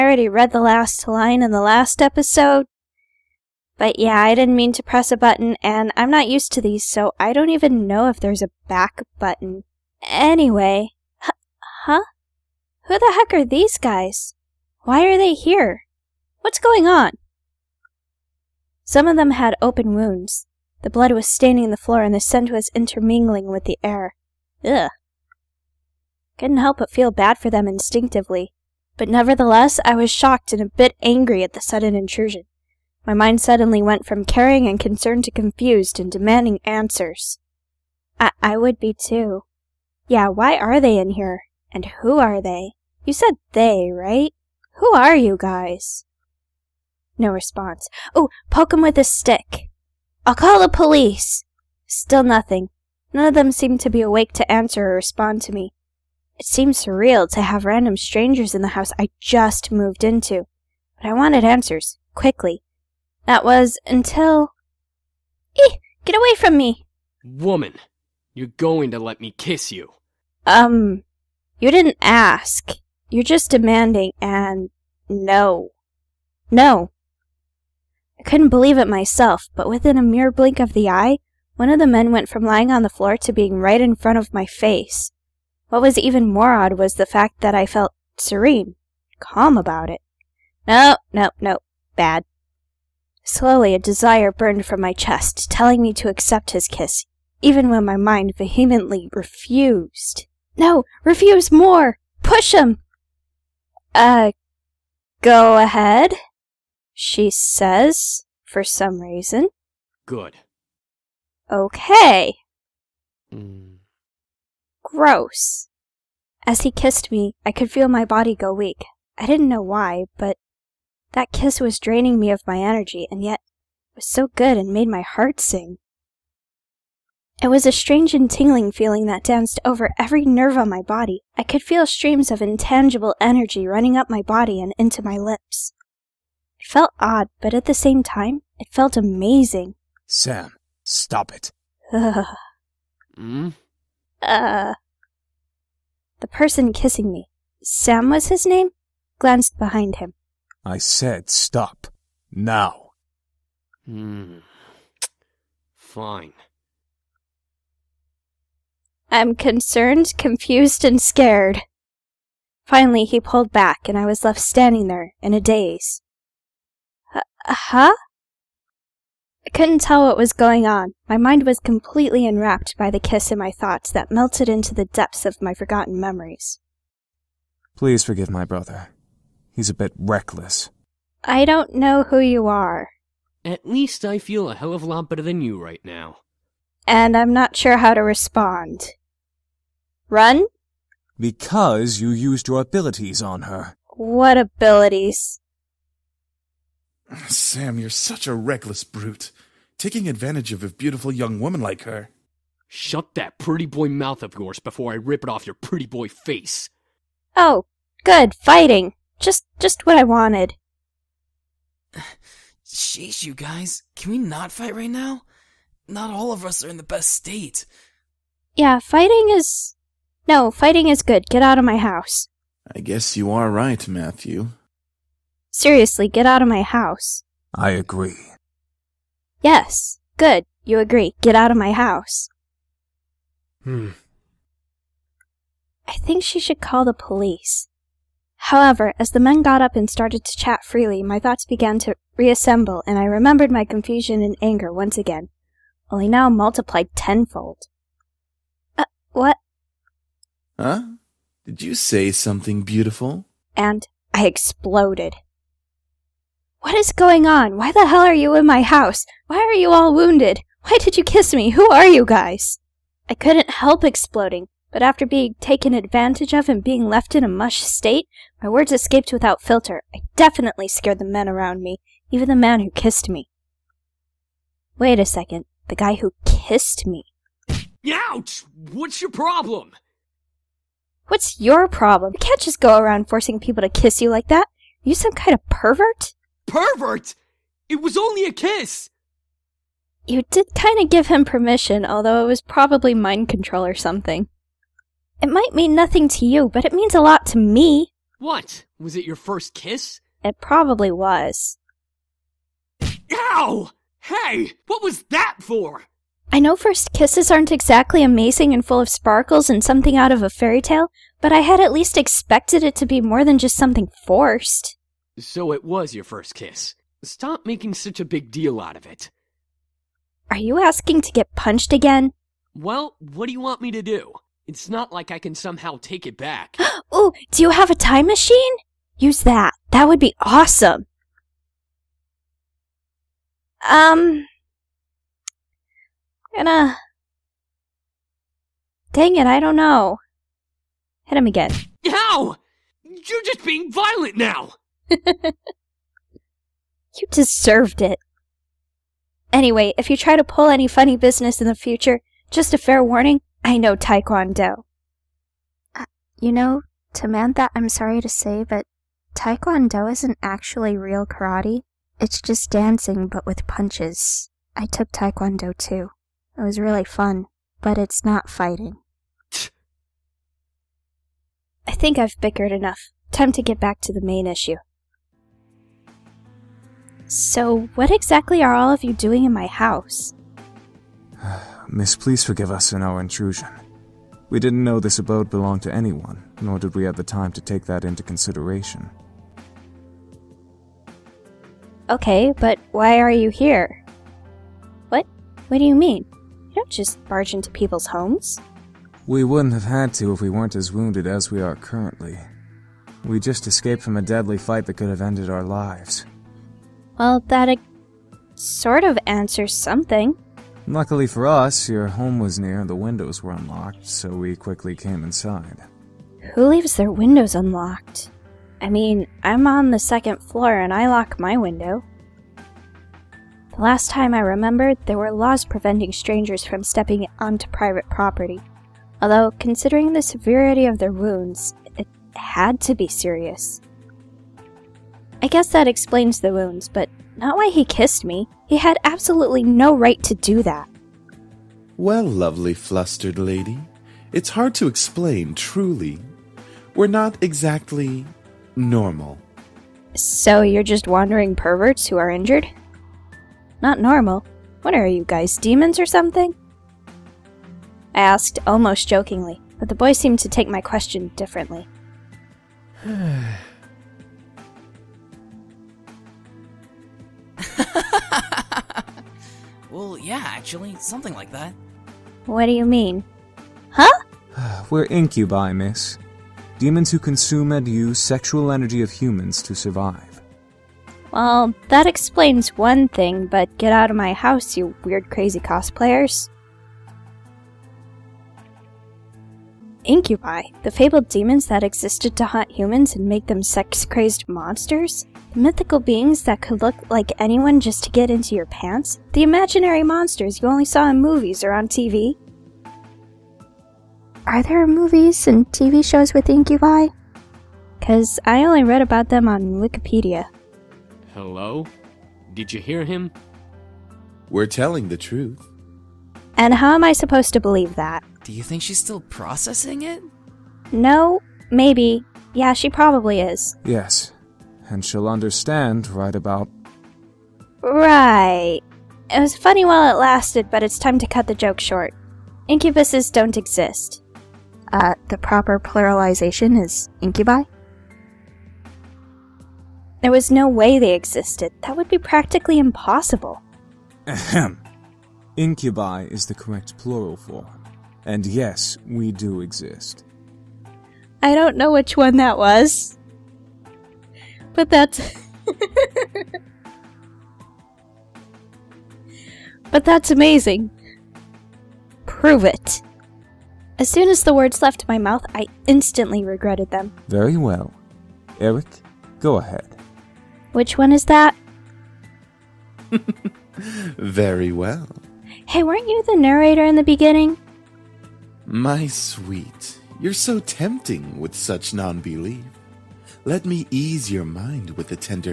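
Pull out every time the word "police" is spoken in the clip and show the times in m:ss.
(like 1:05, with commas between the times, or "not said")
0:50, 3:56.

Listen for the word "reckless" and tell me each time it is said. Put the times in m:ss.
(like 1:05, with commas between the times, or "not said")
2:59, 3:18.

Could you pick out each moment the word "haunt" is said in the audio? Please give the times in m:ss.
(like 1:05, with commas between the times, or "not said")
8:12.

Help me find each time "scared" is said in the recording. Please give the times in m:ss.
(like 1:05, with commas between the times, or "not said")
2:41, 4:30.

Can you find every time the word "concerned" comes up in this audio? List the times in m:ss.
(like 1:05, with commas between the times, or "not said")
0:34, 2:39.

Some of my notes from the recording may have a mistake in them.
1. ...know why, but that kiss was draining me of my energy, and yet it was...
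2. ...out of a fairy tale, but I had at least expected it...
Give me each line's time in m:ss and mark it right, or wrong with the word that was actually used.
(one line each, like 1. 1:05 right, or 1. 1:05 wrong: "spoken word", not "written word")
1. 1:59 right
2. 5:09 right.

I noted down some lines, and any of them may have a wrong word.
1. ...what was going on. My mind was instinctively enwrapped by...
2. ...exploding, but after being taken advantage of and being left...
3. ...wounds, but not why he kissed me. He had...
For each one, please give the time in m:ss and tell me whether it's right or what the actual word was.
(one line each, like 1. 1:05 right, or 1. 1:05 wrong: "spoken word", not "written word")
1. 2:50 wrong: "completely", not "instinctively"
2. 4:23 right
3. 7:16 right.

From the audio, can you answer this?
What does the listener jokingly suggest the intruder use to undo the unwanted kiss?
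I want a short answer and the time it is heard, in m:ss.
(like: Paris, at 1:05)
A time machine, at 5:27.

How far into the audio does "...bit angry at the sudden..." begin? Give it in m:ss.
0:30.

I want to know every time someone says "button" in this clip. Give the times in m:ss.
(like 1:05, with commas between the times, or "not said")
0:05, 0:09.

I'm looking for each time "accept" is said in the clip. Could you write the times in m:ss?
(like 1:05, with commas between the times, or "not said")
1:36.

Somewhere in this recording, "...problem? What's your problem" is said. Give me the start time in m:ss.
4:39.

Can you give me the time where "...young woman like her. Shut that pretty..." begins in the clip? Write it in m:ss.
3:21.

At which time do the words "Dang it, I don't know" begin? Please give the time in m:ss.
5:38.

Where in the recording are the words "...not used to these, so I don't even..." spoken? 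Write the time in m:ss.
0:06.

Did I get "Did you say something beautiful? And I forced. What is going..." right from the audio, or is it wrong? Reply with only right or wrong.
wrong.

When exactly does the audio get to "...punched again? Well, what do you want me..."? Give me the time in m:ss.
5:21.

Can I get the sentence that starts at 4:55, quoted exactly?
It might mean nothing to you, but it means a lot to me.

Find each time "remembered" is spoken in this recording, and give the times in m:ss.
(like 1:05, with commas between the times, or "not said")
4:03, 7:04.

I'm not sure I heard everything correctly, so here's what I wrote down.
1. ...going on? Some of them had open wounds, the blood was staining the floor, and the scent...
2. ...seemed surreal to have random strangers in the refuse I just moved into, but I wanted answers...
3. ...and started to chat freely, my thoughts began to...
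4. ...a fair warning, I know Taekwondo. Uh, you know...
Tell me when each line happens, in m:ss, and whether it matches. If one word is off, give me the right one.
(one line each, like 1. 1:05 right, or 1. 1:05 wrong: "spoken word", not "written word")
1. 0:16 right
2. 0:56 wrong: "house", not "refuse"
3. 3:59 right
4. 5:52 right.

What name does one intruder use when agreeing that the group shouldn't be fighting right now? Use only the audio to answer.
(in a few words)
Matthew.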